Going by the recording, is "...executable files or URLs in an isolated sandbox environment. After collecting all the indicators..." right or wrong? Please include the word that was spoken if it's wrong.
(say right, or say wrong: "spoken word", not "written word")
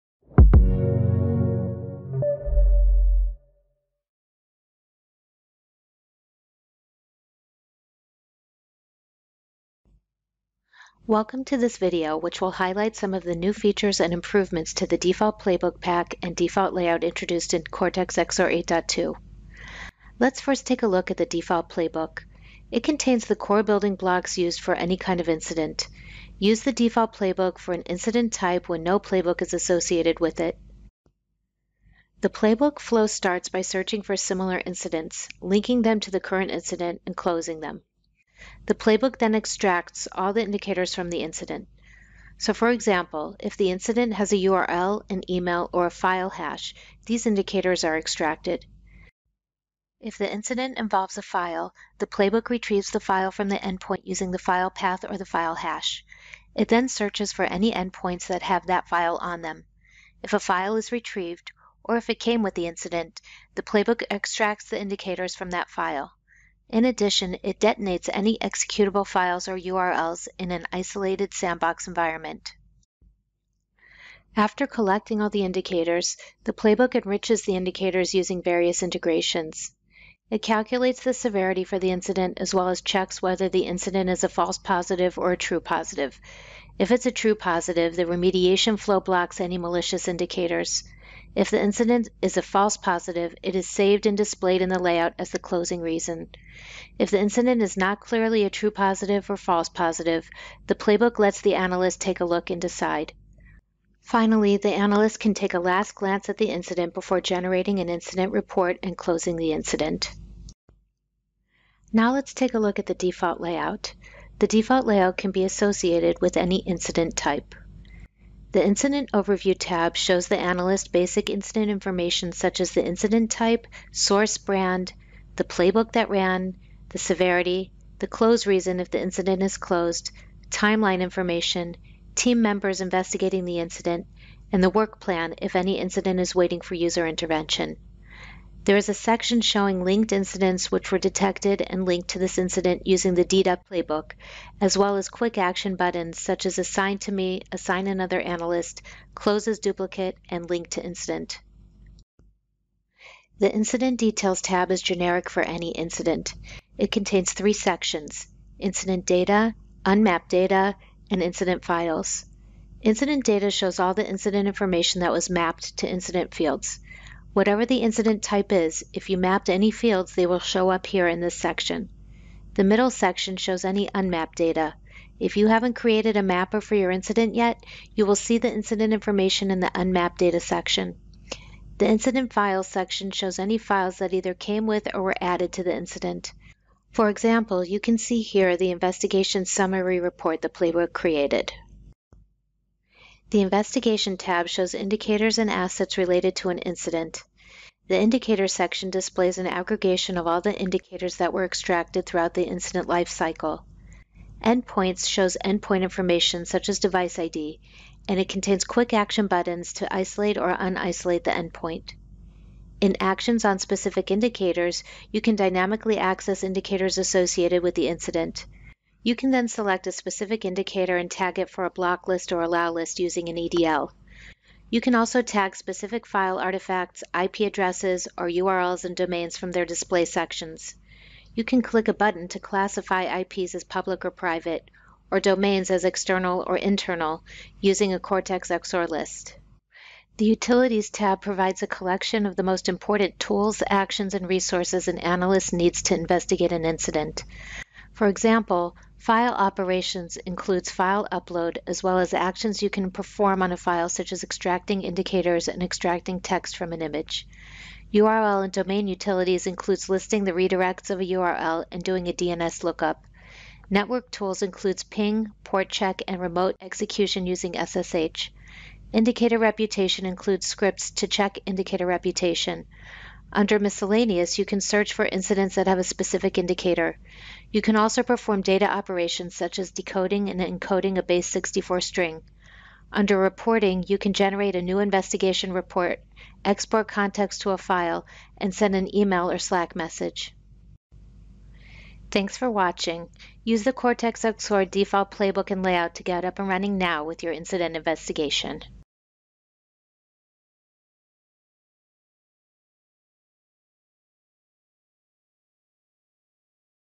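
right.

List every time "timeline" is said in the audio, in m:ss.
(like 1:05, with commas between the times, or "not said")
2:10.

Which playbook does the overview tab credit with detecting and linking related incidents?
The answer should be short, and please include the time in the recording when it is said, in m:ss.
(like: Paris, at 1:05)
DDEP, at 2:23.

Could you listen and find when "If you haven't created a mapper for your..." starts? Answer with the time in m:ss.
2:55.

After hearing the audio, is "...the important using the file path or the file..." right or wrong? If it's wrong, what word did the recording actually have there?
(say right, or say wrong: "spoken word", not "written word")
wrong: "endpoint", not "important".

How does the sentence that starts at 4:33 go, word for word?
Under miscellaneous, you can search for incidents that have a specific indicator.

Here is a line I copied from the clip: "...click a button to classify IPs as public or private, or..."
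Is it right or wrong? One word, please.
right.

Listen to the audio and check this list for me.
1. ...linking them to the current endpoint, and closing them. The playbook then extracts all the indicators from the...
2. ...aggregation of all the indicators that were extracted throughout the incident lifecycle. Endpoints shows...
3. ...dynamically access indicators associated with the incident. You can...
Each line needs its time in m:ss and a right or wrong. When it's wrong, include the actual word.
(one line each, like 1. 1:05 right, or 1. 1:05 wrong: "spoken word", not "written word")
1. 0:35 wrong: "incident", not "endpoint"
2. 3:19 right
3. 3:35 right.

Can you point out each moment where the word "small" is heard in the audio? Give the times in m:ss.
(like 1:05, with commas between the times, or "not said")
not said.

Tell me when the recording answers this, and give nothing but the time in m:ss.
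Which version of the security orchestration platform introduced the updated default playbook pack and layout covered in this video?
0:18.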